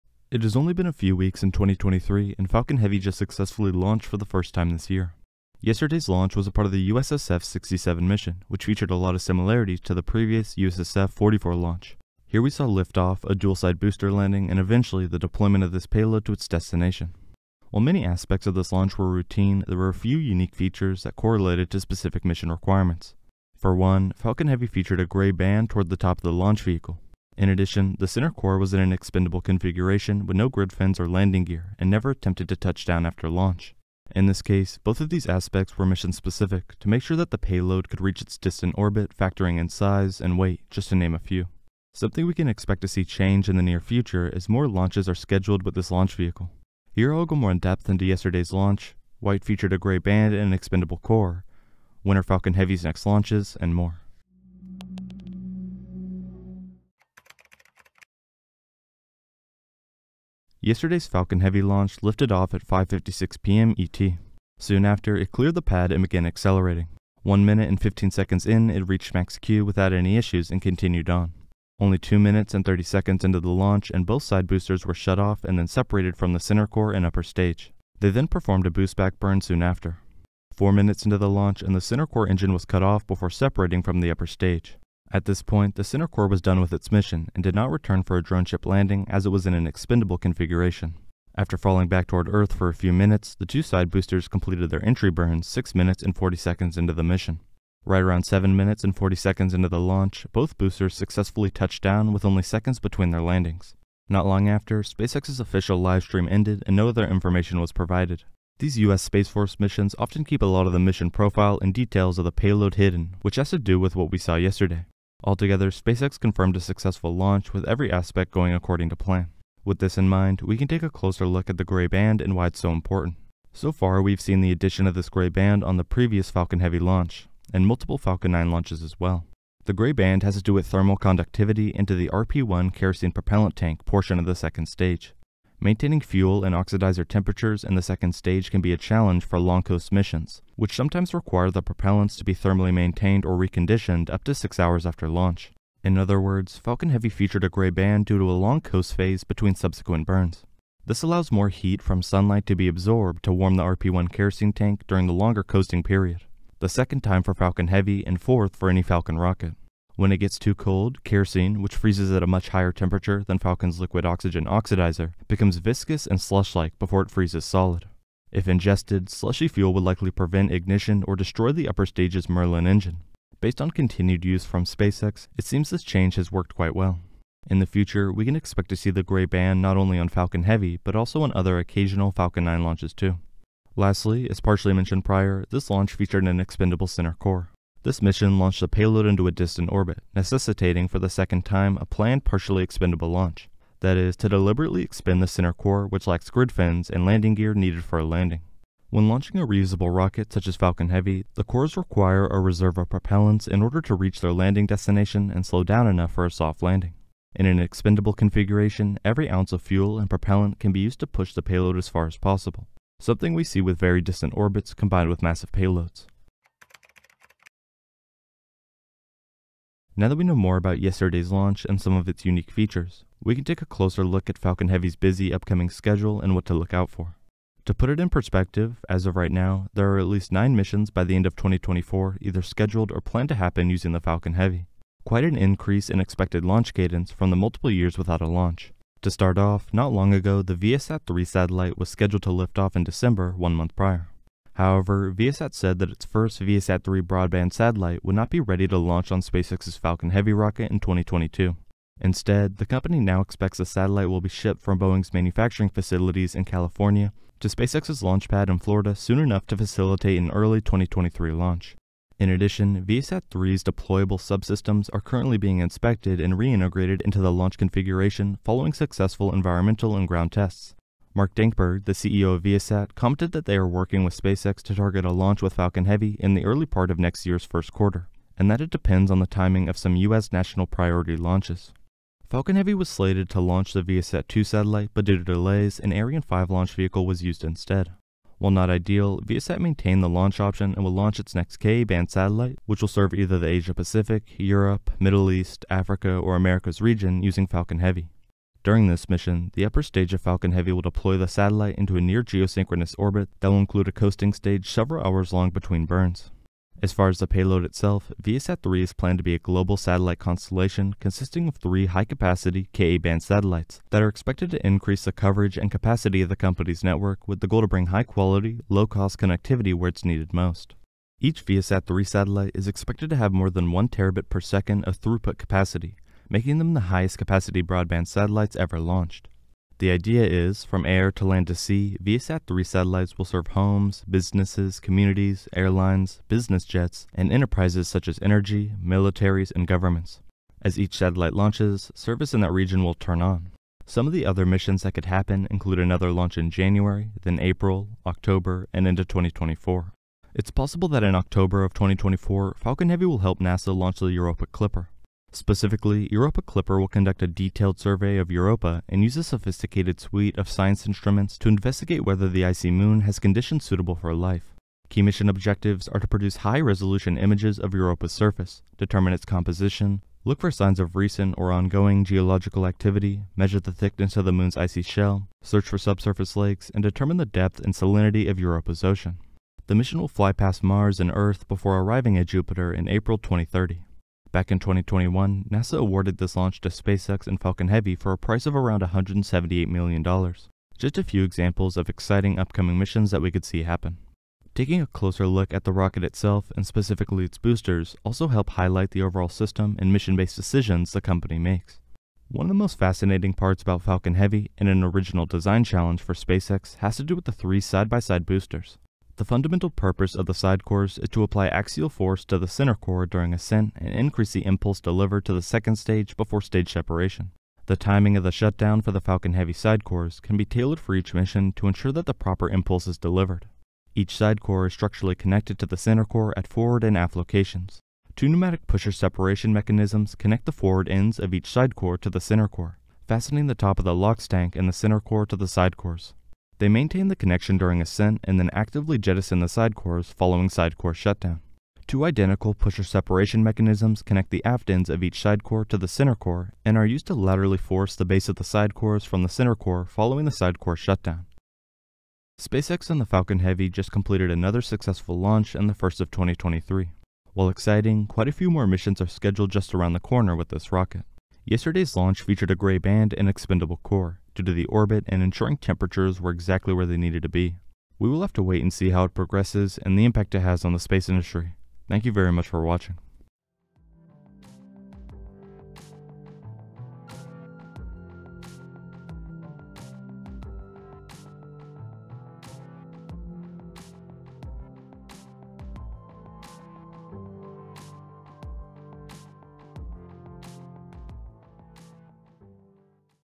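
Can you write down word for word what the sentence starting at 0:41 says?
Something we can expect to see change in the near future as more launches are scheduled with this launch vehicle.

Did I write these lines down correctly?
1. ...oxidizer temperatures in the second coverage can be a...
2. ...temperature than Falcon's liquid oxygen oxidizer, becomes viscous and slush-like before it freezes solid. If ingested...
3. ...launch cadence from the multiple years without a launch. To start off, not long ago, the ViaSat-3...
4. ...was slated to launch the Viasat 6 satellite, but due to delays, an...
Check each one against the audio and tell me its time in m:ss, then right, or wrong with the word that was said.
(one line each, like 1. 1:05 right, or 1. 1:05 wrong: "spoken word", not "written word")
1. 2:16 wrong: "stage", not "coverage"
2. 2:42 right
3. 3:56 right
4. 4:42 wrong: "2", not "6".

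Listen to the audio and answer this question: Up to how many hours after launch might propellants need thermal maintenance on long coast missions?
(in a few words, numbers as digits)
6 hours.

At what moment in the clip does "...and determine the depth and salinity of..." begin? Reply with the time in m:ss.
6:16.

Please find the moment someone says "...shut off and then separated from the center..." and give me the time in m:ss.
1:14.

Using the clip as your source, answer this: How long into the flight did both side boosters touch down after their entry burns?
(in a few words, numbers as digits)
7 minutes and 40 seconds.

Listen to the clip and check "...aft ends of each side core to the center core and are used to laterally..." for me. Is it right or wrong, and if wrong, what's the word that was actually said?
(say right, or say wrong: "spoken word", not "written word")
right.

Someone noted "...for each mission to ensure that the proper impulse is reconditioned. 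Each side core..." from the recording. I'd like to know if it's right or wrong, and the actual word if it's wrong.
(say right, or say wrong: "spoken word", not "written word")
wrong: "delivered", not "reconditioned".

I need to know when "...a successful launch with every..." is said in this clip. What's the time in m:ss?
1:56.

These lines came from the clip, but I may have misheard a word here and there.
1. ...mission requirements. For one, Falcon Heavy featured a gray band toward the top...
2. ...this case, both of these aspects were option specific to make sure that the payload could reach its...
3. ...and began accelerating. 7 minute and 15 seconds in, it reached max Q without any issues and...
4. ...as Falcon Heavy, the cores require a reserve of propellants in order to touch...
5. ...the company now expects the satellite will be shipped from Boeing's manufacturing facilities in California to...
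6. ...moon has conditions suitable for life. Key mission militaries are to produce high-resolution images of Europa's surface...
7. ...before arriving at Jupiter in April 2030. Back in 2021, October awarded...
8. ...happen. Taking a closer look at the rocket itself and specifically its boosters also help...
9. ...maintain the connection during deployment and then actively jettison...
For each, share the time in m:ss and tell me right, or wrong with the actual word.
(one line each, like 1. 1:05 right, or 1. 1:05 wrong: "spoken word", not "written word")
1. 0:22 right
2. 0:34 wrong: "mission", not "option"
3. 1:05 wrong: "1", not "7"
4. 3:20 wrong: "reach", not "touch"
5. 4:12 right
6. 6:02 wrong: "objectives", not "militaries"
7. 6:21 wrong: "NASA", not "October"
8. 6:33 right
9. 7:16 wrong: "ascent", not "deployment".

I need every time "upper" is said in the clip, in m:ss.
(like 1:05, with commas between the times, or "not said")
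1:17, 1:24, 2:51, 4:59.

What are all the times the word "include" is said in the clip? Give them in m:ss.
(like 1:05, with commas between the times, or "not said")
5:03, 5:45.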